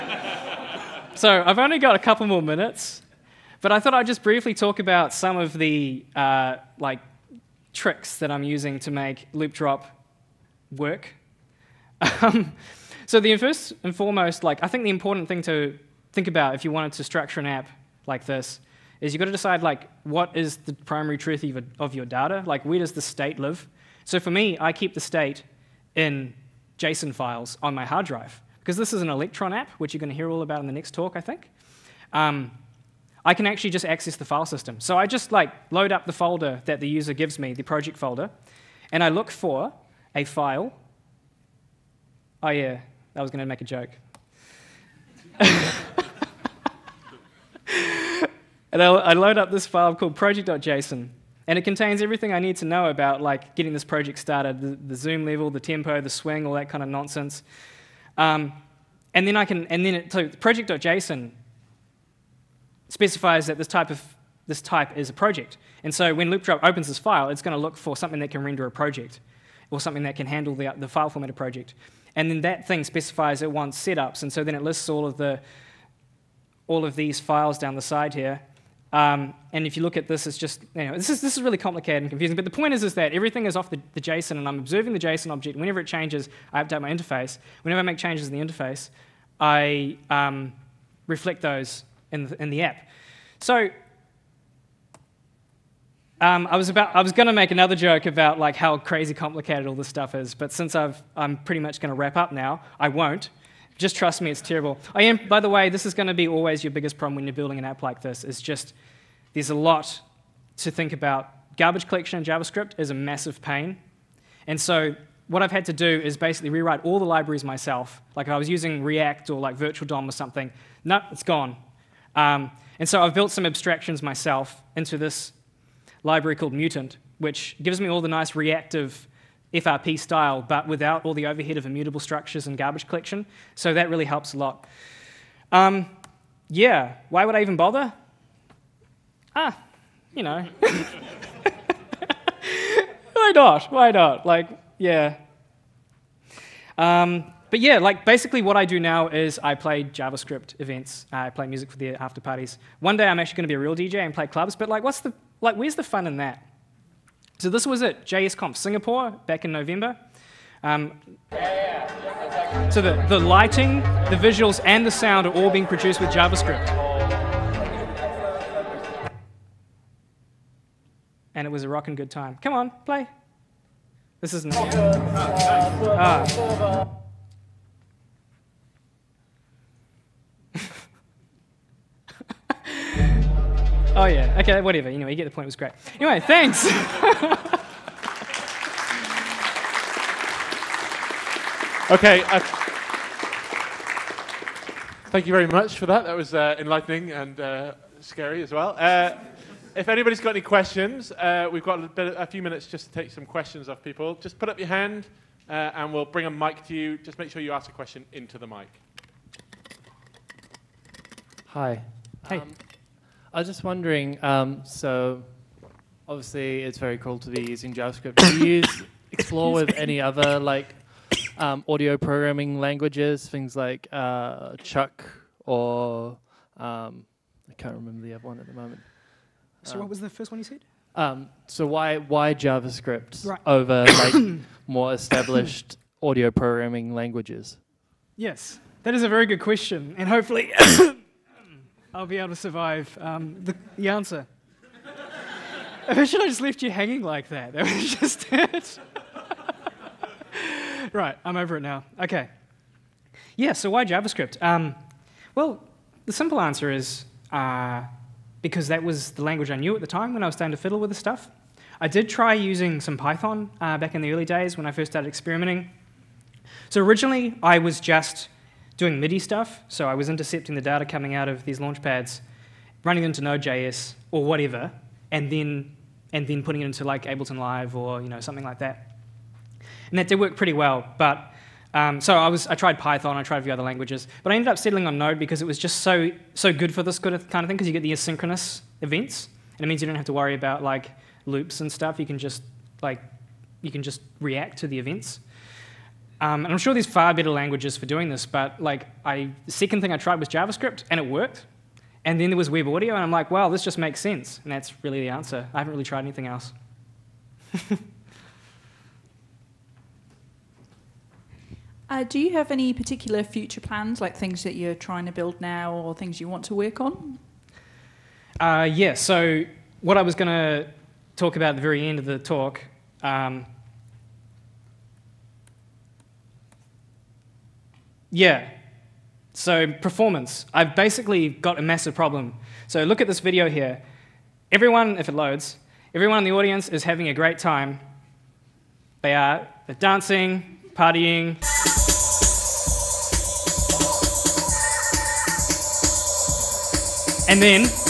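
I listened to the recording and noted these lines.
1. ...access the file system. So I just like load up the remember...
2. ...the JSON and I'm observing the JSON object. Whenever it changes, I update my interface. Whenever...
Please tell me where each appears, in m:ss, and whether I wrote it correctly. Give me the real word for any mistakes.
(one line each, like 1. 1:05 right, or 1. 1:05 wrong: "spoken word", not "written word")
1. 0:33 wrong: "folder", not "remember"
2. 1:23 right.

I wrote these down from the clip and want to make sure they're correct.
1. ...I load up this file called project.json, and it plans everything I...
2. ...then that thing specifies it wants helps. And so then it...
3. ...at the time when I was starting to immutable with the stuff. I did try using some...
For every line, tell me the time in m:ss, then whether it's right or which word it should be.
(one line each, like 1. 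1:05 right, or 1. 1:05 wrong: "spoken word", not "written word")
1. 0:48 wrong: "contains", not "plans"
2. 1:12 wrong: "setups", not "helps"
3. 4:19 wrong: "fiddle", not "immutable".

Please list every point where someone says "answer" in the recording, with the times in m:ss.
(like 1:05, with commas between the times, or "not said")
4:03, 4:16, 5:05.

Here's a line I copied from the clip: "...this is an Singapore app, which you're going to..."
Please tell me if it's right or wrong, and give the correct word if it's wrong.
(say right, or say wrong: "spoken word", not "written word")
wrong: "Electron", not "Singapore".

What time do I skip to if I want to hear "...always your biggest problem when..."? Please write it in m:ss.
1:46.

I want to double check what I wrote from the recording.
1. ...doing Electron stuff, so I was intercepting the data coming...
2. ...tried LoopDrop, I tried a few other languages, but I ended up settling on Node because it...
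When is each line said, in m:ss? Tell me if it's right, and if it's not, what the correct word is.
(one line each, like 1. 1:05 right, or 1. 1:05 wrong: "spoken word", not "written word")
1. 4:28 wrong: "MIDI", not "Electron"
2. 4:42 wrong: "Python", not "LoopDrop".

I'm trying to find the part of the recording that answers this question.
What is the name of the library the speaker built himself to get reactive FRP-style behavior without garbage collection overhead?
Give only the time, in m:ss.
2:06.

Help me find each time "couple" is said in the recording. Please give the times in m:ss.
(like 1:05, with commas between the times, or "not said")
0:01.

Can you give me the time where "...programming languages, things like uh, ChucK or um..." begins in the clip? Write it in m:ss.
3:41.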